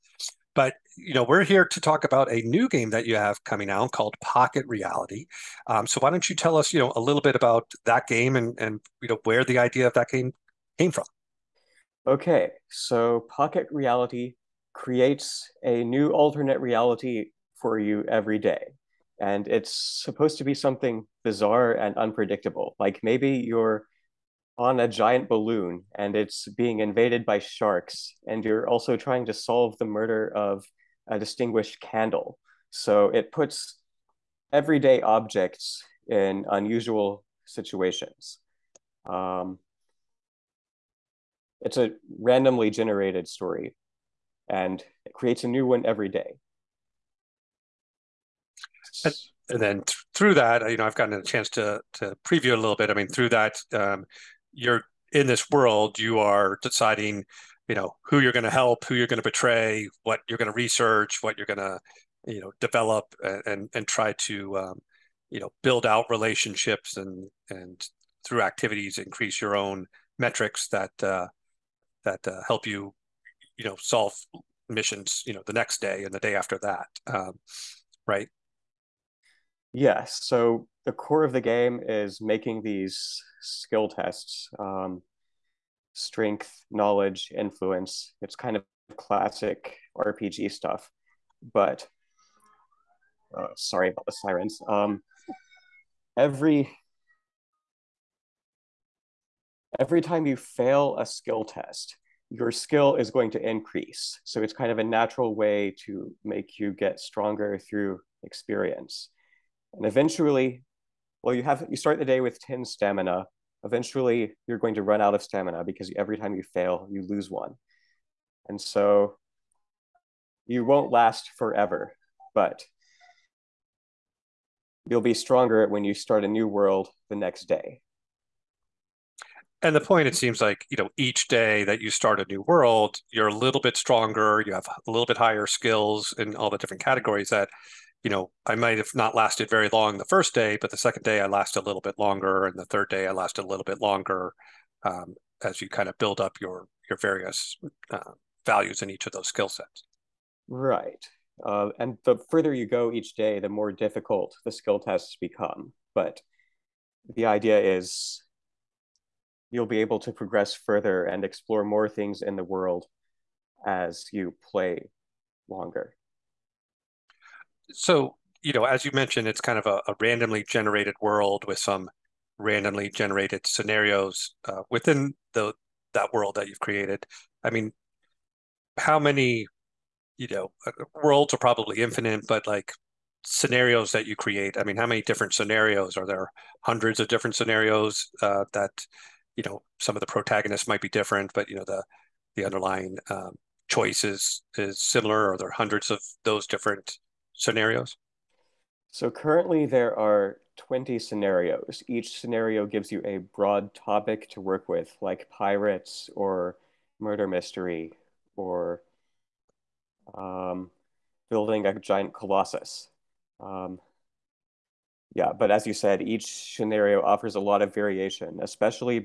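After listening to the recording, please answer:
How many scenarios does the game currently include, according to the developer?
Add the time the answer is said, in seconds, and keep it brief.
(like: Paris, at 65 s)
20, at 200 s.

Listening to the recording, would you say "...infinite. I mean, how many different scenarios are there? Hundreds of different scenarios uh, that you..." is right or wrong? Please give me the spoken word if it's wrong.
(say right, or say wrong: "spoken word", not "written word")
wrong: "create", not "infinite".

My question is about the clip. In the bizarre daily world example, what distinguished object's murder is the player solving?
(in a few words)
Candle.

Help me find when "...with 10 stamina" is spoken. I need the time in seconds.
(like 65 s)
112 s.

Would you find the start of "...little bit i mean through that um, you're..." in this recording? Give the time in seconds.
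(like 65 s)
52 s.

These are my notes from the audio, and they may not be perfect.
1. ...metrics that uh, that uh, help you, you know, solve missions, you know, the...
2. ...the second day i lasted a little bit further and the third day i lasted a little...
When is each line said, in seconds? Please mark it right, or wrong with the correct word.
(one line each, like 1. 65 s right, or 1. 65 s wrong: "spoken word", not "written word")
1. 70 s right
2. 140 s wrong: "longer", not "further".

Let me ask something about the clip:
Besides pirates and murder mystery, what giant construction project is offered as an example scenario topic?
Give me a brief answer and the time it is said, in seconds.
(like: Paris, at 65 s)
Building a giant colossus, at 211 s.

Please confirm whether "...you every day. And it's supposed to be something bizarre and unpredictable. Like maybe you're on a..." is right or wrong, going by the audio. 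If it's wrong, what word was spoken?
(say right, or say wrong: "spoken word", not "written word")
right.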